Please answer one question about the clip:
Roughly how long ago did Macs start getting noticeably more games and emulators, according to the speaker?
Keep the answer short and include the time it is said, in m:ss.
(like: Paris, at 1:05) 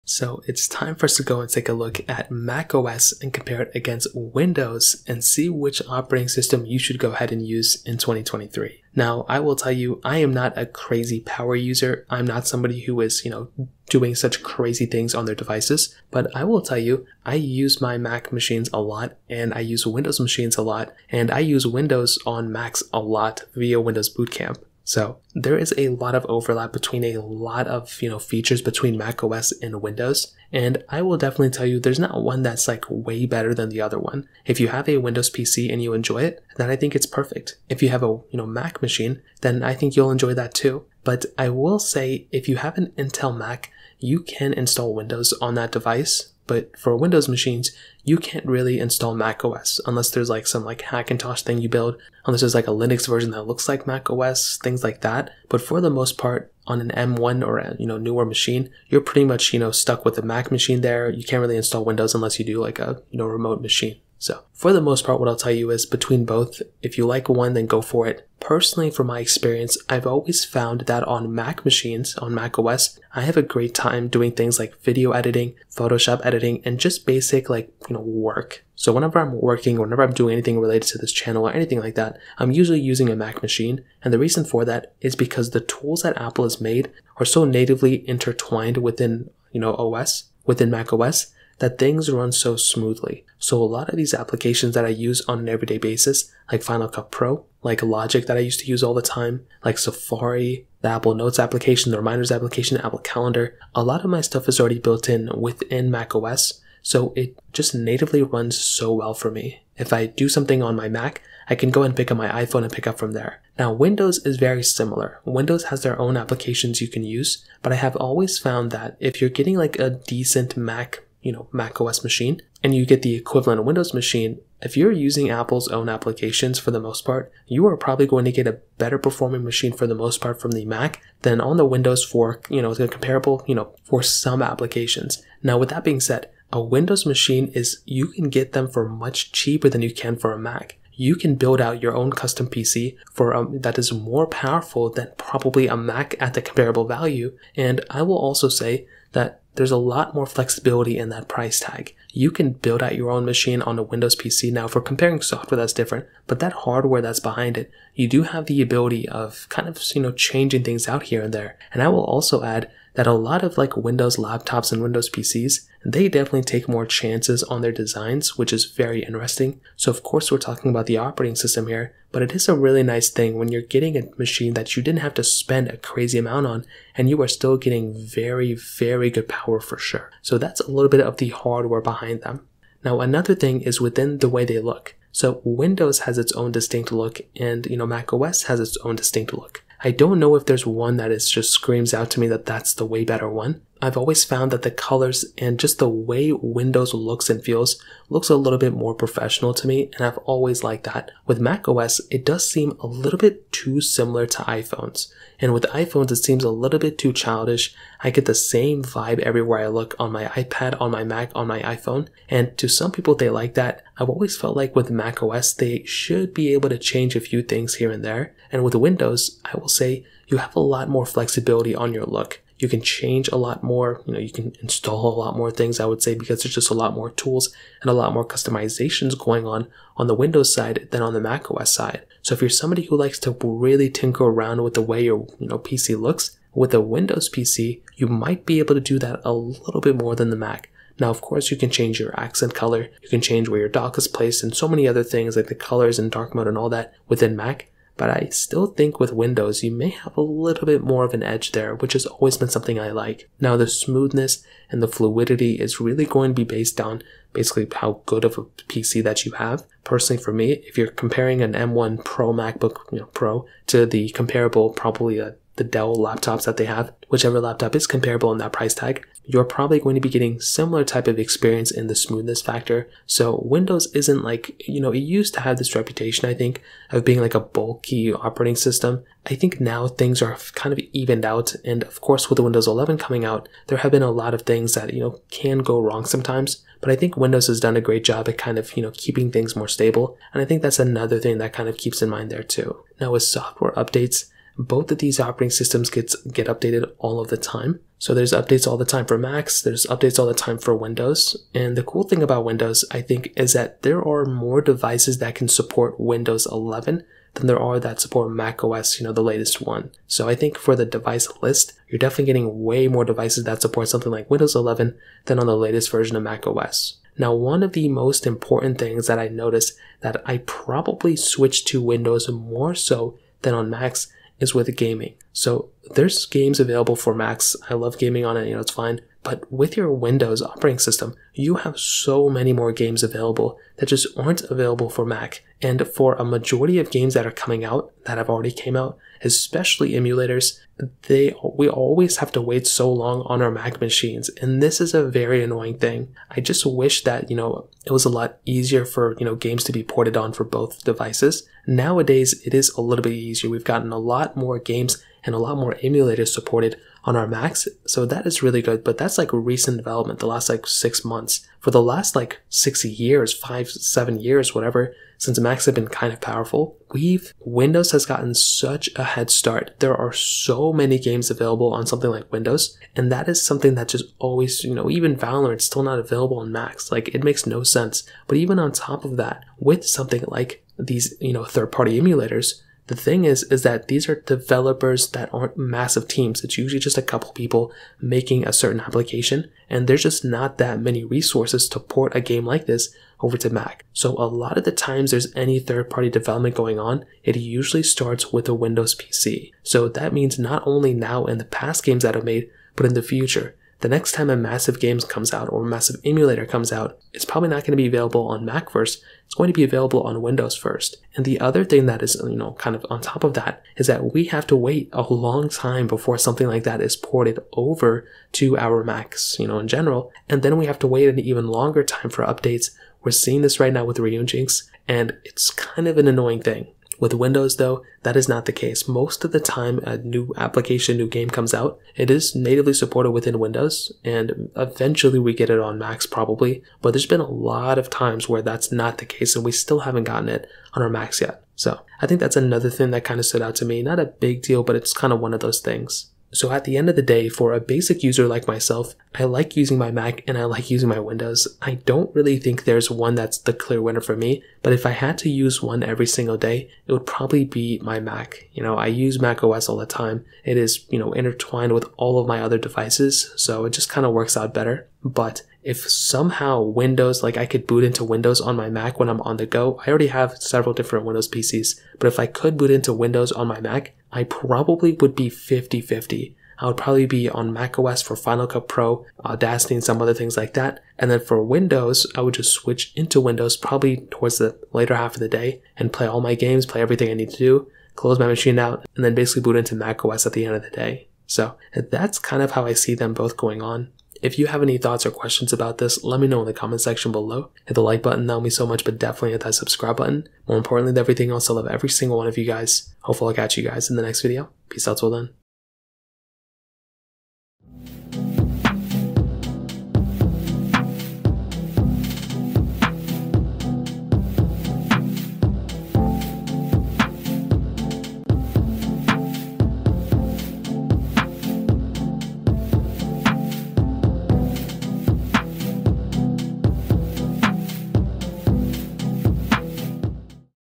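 six months, at 6:00.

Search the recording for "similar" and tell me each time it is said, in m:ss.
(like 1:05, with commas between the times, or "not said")
1:54, 3:23, 4:30.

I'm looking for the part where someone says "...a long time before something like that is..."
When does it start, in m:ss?
6:54.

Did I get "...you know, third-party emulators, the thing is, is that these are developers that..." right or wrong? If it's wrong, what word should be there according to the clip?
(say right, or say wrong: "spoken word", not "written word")
right.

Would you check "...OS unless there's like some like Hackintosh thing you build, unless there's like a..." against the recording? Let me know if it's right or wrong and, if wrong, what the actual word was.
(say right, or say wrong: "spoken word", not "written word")
right.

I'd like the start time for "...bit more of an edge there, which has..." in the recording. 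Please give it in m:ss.
4:10.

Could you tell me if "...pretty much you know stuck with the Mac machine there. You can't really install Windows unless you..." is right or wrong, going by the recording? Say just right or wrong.
right.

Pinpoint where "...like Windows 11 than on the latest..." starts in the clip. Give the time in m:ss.
5:14.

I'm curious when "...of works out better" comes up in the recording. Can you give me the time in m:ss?
7:44.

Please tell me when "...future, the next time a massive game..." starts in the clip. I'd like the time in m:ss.
6:43.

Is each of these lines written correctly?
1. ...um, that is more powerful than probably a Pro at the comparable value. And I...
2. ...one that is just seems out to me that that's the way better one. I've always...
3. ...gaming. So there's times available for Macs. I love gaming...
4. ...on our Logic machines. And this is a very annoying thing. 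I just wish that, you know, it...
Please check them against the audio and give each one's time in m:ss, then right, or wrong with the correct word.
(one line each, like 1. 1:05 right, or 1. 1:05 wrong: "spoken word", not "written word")
1. 2:23 wrong: "Mac", not "Pro"
2. 3:10 wrong: "screams", not "seems"
3. 5:24 wrong: "games", not "times"
4. 5:43 wrong: "Mac", not "Logic".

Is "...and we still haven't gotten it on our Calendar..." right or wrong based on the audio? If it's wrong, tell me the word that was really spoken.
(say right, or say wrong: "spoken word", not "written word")
wrong: "Macs", not "Calendar".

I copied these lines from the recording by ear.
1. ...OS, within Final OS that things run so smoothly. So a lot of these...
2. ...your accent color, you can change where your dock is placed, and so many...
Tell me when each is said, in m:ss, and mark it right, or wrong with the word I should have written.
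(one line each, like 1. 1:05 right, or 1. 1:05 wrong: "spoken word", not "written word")
1. 1:29 wrong: "Mac", not "Final"
2. 4:01 right.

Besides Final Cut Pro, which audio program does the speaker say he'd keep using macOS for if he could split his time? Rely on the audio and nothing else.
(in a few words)
Audacity.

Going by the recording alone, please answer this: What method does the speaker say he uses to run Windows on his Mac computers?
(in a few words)
Boot Camp.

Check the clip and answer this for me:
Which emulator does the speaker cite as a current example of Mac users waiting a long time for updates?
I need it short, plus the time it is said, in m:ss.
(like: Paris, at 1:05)
Ryujinx, at 7:03.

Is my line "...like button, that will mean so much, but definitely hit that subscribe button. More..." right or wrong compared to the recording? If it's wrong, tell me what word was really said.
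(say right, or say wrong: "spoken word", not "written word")
right.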